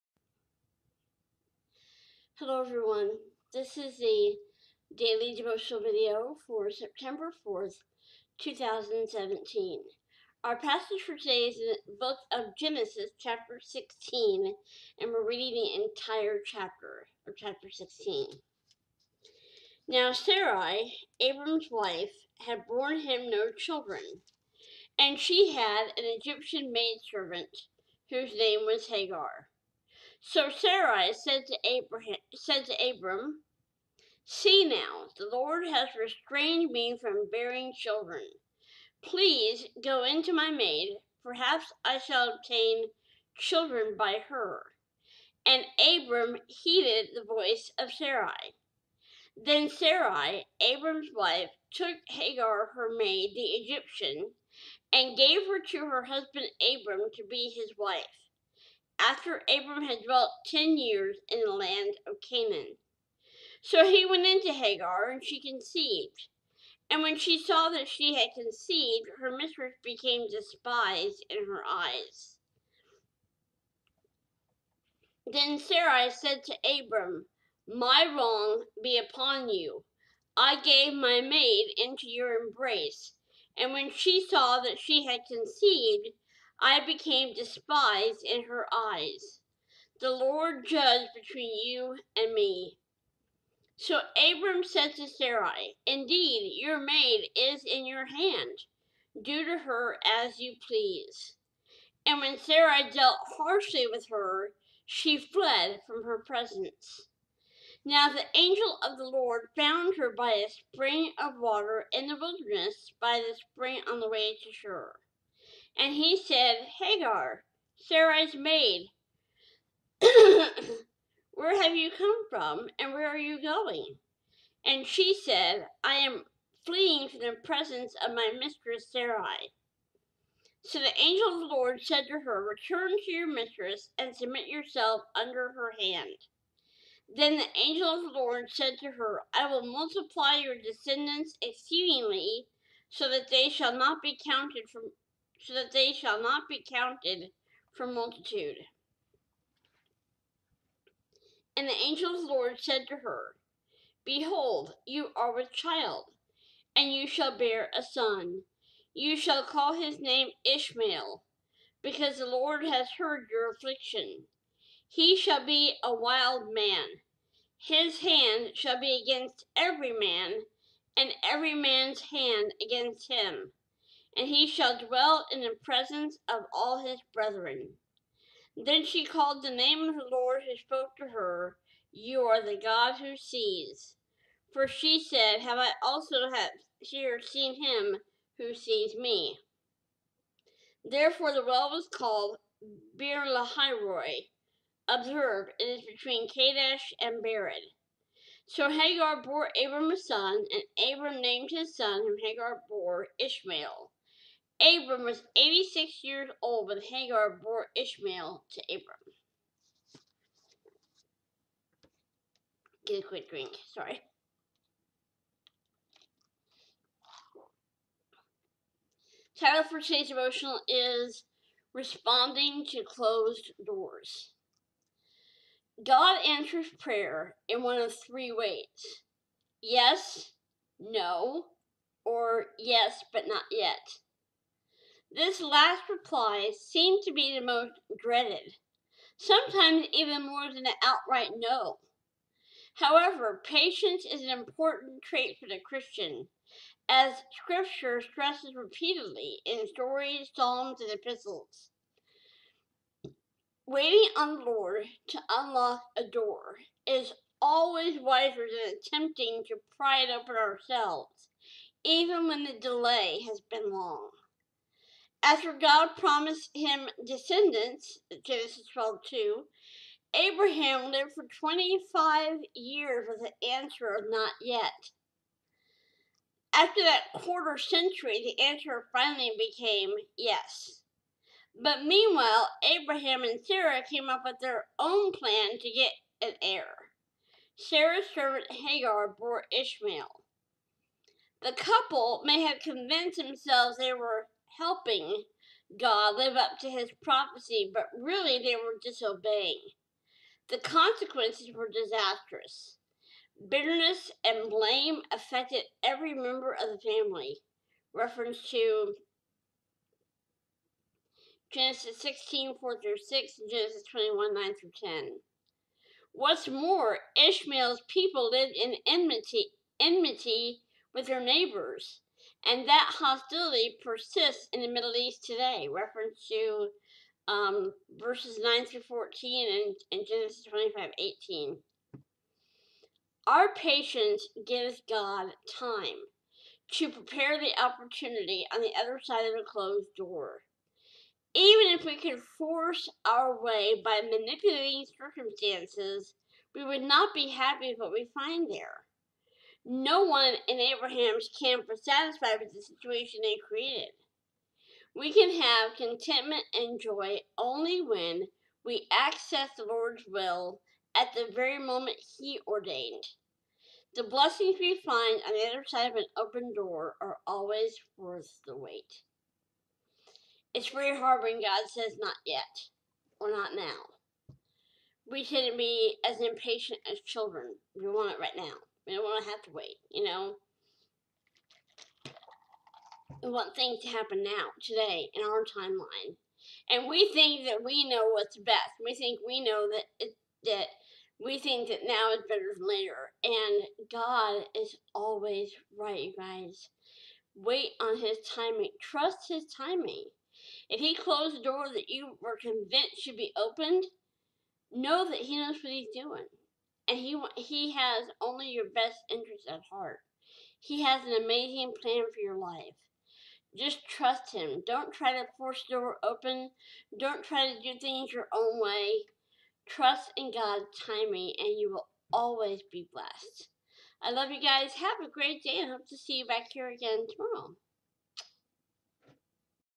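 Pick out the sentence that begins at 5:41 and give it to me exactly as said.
Even if we could force our way by manipulating circumstances, we would not be happy with what we find there.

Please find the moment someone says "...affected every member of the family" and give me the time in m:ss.
5:05.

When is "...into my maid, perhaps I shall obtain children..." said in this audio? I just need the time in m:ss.
0:40.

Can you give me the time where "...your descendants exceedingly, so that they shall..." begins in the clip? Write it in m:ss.
2:20.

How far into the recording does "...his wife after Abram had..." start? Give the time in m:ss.
0:57.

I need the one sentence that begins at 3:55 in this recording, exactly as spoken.
This last reply seemed to be the most dreaded, sometimes even more than an outright no.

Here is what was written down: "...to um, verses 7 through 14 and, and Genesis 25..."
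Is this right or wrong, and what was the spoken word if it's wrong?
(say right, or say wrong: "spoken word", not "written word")
wrong: "9", not "7".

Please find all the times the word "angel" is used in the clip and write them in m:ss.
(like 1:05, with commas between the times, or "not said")
1:48, 2:11, 2:17, 2:31.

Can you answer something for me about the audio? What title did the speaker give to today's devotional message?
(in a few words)
Responding to Closed Doors.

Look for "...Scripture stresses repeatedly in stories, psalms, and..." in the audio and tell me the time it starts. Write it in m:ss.
4:07.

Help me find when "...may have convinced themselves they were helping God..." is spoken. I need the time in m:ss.
4:52.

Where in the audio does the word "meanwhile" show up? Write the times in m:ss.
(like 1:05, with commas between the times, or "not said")
4:41.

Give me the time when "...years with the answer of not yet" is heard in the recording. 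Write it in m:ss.
4:32.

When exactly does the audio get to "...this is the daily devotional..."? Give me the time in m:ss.
0:03.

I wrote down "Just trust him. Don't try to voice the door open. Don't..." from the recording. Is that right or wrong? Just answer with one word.
wrong.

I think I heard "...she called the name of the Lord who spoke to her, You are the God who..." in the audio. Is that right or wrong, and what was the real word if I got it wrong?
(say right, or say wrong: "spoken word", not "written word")
right.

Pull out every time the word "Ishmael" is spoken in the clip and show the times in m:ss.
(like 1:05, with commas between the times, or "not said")
2:40, 3:23, 3:27, 4:49, 5:17.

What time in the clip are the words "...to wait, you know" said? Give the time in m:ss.
6:19.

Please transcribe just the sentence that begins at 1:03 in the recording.
So he went into Hagar, and she conceived.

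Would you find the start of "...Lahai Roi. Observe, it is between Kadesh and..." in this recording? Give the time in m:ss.
3:13.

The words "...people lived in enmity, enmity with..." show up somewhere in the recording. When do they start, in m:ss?
5:17.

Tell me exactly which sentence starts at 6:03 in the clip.
The blessings we find on the other side of an open door are always worth the wait.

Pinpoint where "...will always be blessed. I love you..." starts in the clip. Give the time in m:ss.
7:01.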